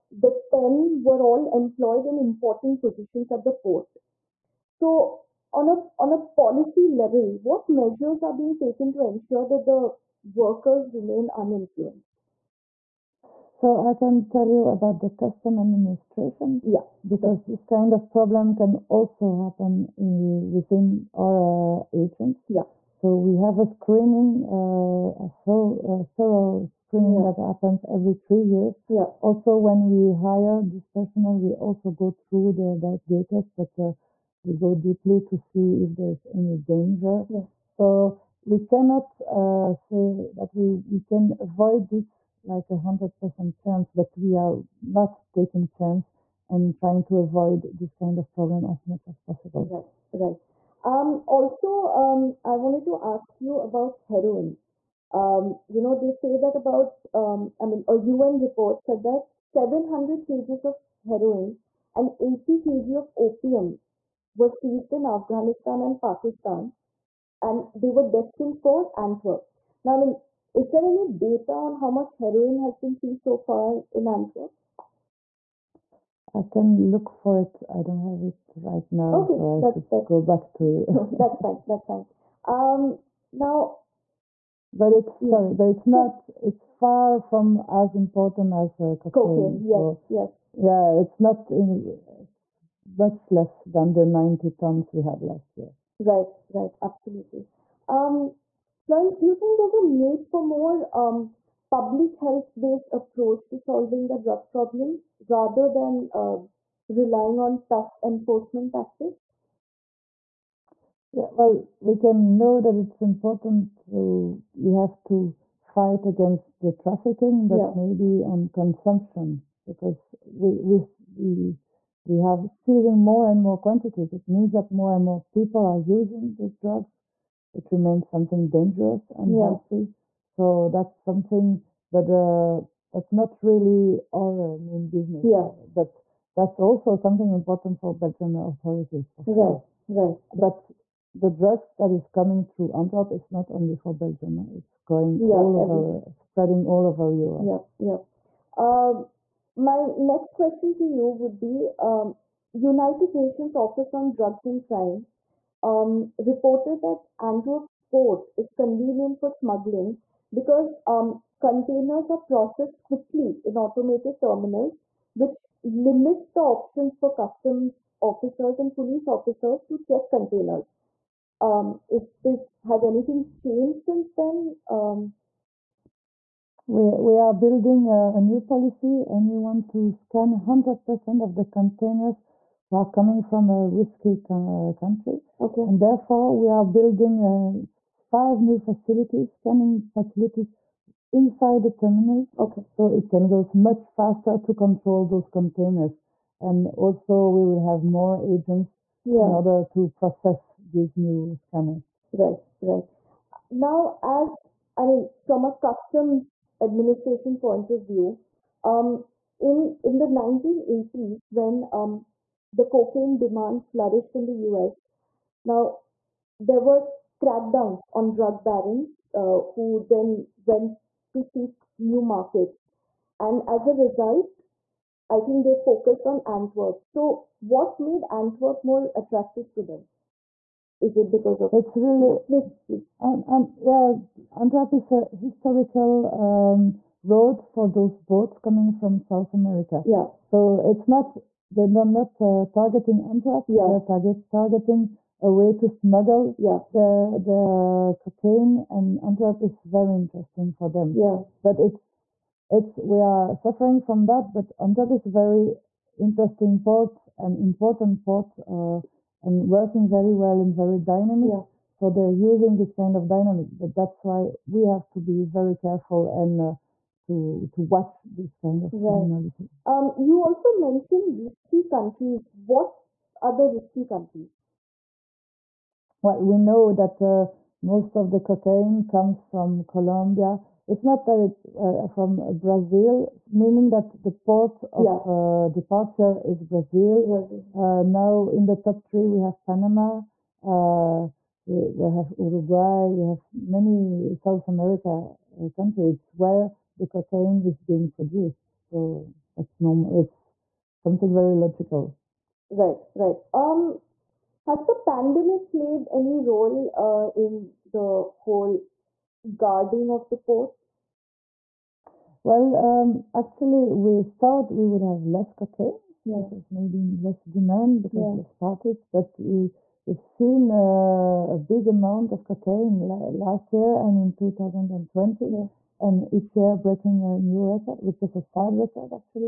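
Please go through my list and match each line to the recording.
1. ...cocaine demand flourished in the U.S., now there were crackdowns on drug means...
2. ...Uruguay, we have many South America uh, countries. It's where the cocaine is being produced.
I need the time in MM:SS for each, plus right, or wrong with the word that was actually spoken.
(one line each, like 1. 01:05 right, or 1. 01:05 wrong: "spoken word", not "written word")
1. 03:32 wrong: "barons", not "means"
2. 04:52 right.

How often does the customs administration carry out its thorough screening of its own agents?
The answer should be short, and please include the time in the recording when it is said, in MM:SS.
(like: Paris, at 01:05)
Every 3 years, at 00:27.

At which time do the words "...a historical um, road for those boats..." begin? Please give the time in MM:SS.
03:54.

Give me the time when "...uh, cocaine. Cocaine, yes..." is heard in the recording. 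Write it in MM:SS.
01:28.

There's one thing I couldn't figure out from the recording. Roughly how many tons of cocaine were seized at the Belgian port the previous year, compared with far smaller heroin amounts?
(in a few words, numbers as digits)
90 tons.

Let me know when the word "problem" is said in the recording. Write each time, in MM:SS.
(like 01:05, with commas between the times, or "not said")
00:18, 00:48, 01:44.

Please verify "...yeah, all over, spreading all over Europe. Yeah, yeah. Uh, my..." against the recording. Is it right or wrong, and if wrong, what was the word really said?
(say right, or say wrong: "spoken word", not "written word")
right.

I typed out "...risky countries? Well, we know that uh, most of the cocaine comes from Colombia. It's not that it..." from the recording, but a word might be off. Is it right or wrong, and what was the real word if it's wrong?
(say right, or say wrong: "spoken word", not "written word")
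right.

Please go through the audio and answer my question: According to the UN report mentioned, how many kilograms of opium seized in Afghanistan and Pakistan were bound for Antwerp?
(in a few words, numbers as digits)
80 kg.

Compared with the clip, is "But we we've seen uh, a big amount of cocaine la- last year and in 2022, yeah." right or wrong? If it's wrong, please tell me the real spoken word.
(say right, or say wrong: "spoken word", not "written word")
wrong: "2020", not "2022".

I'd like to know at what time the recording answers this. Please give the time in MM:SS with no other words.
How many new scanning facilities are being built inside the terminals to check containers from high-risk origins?
03:07.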